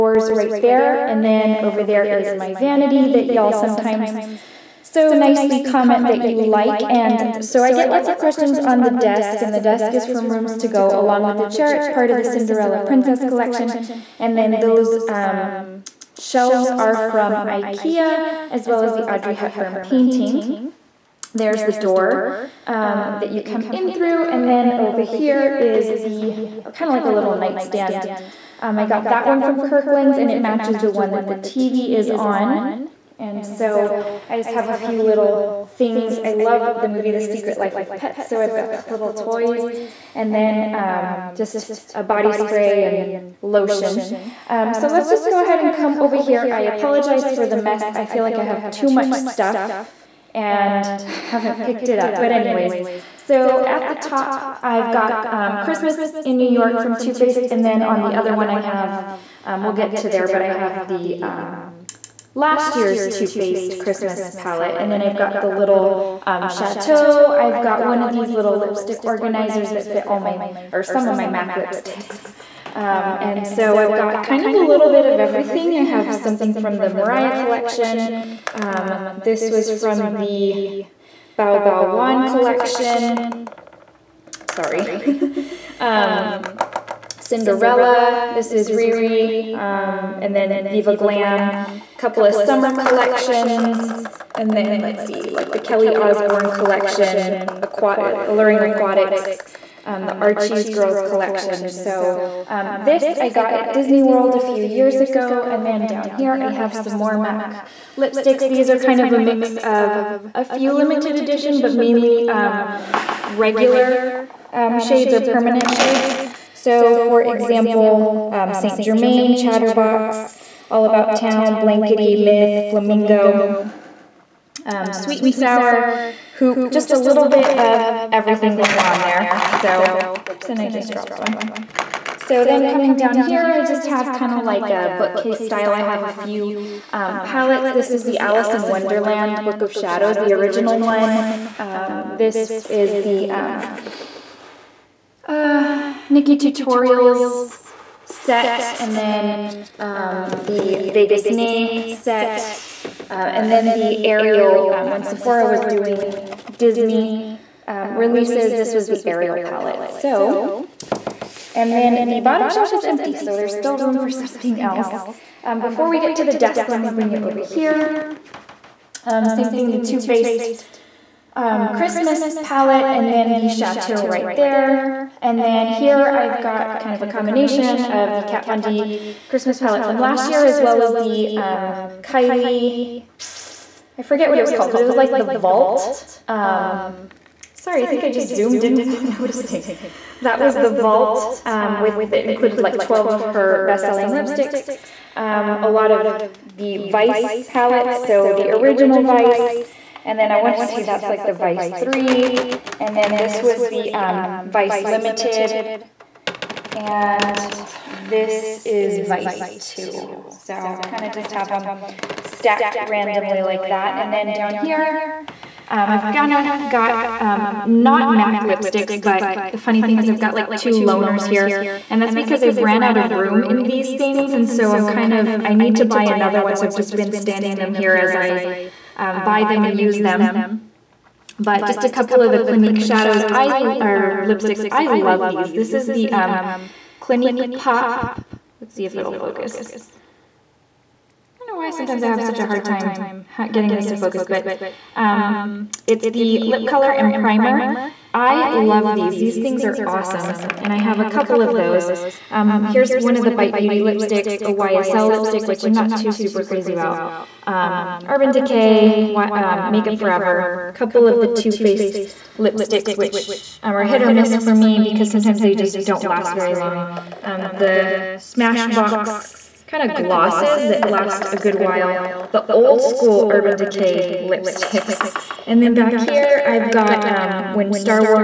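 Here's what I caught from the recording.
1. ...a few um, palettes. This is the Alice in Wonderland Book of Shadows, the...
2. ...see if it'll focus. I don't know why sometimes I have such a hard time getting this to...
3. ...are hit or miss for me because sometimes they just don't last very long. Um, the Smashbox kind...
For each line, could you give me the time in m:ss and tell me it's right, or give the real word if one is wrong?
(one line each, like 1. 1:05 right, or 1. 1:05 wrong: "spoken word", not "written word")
1. 2:16 right
2. 3:58 right
3. 4:23 right.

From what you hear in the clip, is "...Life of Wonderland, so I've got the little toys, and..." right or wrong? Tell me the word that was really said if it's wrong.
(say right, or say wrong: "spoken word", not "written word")
wrong: "Pets", not "Wonderland".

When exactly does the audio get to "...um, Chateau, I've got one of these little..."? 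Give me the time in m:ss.
1:06.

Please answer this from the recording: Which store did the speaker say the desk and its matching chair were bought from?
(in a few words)
Rooms to Go.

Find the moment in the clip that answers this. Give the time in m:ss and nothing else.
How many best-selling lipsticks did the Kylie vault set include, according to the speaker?
3:12.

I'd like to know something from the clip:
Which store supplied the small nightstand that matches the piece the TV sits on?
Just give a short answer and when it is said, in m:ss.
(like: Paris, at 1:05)
Kirkland's, at 0:29.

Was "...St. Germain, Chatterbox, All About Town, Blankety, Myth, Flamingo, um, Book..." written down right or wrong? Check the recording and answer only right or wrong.
wrong.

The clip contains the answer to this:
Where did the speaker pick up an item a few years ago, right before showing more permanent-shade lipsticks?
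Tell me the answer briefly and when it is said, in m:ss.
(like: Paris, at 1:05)
Disney World, at 1:43.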